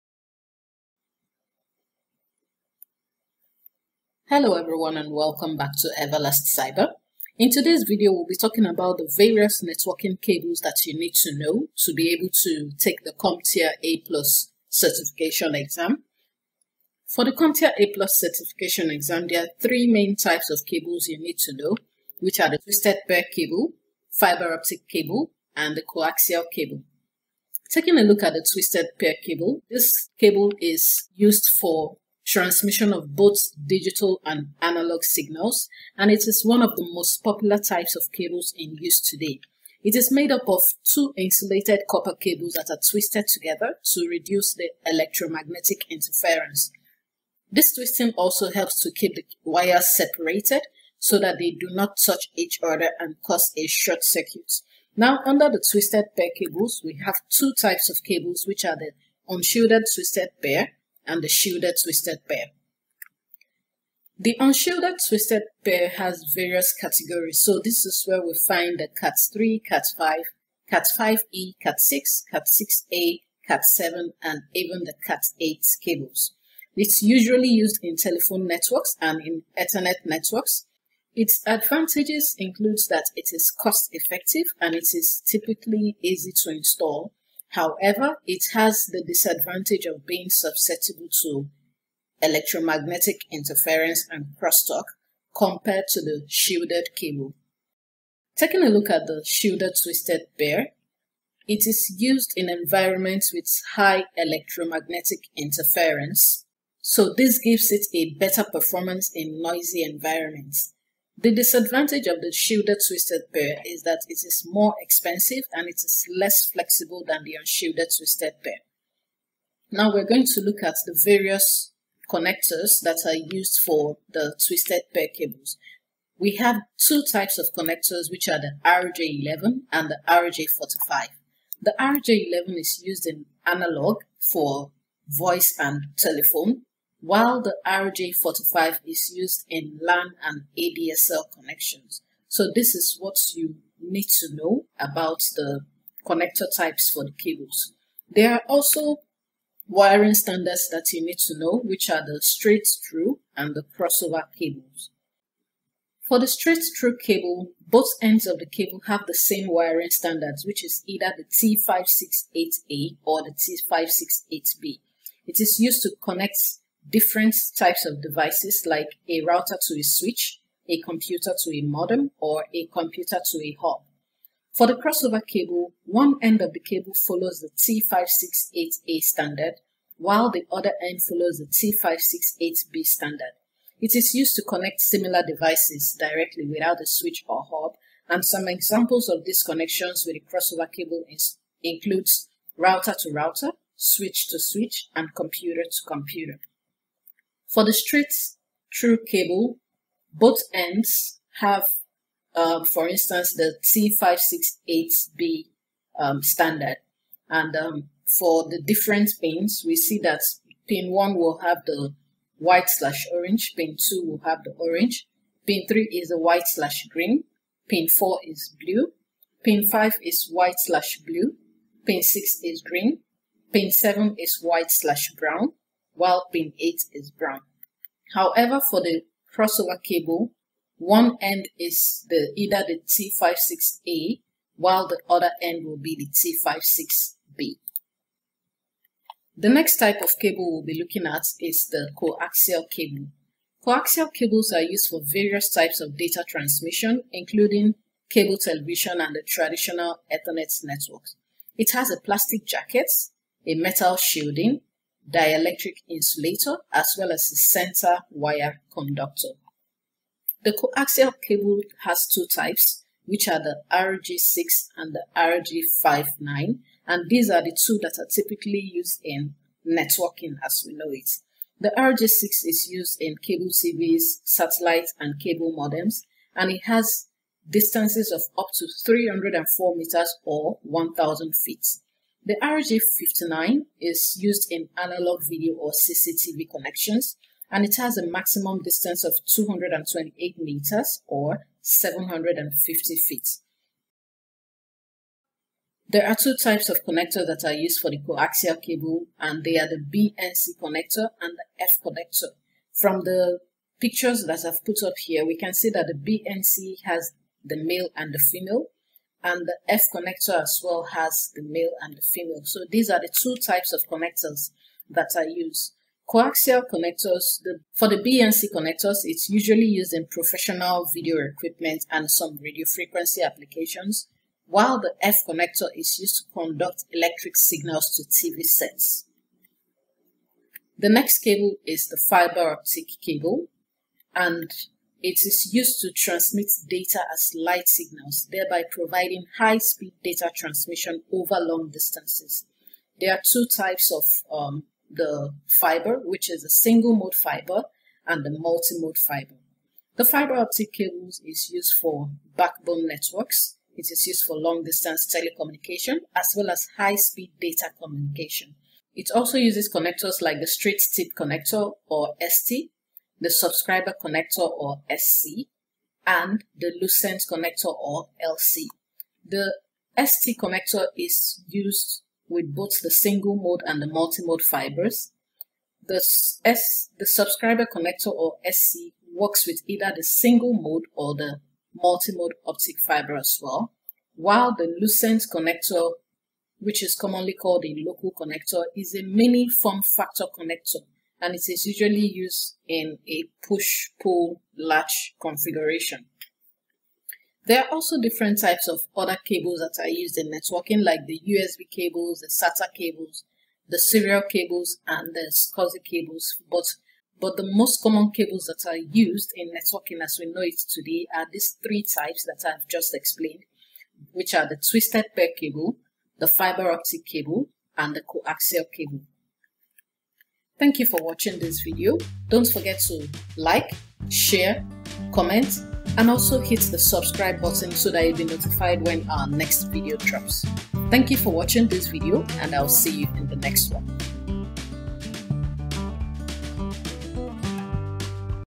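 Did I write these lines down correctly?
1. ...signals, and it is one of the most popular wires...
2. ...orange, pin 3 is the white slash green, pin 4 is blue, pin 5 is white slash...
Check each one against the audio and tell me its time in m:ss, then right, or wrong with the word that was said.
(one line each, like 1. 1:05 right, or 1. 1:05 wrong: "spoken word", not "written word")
1. 0:35 wrong: "types", not "wires"
2. 3:34 right.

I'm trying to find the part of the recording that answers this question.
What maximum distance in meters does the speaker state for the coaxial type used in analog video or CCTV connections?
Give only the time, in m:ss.
4:49.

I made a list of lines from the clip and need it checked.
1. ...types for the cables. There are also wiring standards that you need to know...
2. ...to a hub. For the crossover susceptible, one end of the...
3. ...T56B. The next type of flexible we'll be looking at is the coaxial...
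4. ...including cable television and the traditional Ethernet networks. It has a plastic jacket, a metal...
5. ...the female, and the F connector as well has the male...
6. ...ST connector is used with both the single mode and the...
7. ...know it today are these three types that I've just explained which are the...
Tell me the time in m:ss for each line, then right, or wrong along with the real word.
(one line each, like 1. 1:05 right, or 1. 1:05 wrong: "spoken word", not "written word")
1. 2:26 right
2. 2:53 wrong: "cable", not "susceptible"
3. 3:56 wrong: "cable", not "flexible"
4. 4:07 right
5. 5:08 right
6. 6:10 right
7. 6:50 right.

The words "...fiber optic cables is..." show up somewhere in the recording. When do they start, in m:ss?
5:50.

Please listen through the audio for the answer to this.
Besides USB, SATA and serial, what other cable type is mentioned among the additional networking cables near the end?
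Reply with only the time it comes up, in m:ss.
6:45.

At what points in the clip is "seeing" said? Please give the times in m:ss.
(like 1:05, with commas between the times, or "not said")
not said.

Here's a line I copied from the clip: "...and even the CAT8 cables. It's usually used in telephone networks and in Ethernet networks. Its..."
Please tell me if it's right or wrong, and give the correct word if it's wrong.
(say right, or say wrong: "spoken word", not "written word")
right.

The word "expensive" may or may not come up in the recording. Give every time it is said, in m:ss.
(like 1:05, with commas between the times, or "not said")
1:54.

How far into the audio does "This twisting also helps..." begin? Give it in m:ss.
0:47.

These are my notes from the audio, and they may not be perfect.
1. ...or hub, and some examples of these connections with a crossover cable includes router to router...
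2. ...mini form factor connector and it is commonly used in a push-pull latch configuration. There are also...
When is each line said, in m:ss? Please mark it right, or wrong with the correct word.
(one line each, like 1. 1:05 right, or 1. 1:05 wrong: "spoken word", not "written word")
1. 3:07 right
2. 6:29 wrong: "usually", not "commonly".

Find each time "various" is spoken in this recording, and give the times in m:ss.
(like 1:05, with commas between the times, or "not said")
0:09, 1:06, 2:01, 4:05.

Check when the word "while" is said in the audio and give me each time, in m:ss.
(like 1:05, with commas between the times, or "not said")
2:17, 2:59, 3:46, 3:54, 5:24, 6:24.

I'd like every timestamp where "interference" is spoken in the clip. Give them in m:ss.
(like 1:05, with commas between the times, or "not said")
0:45, 1:33, 1:45.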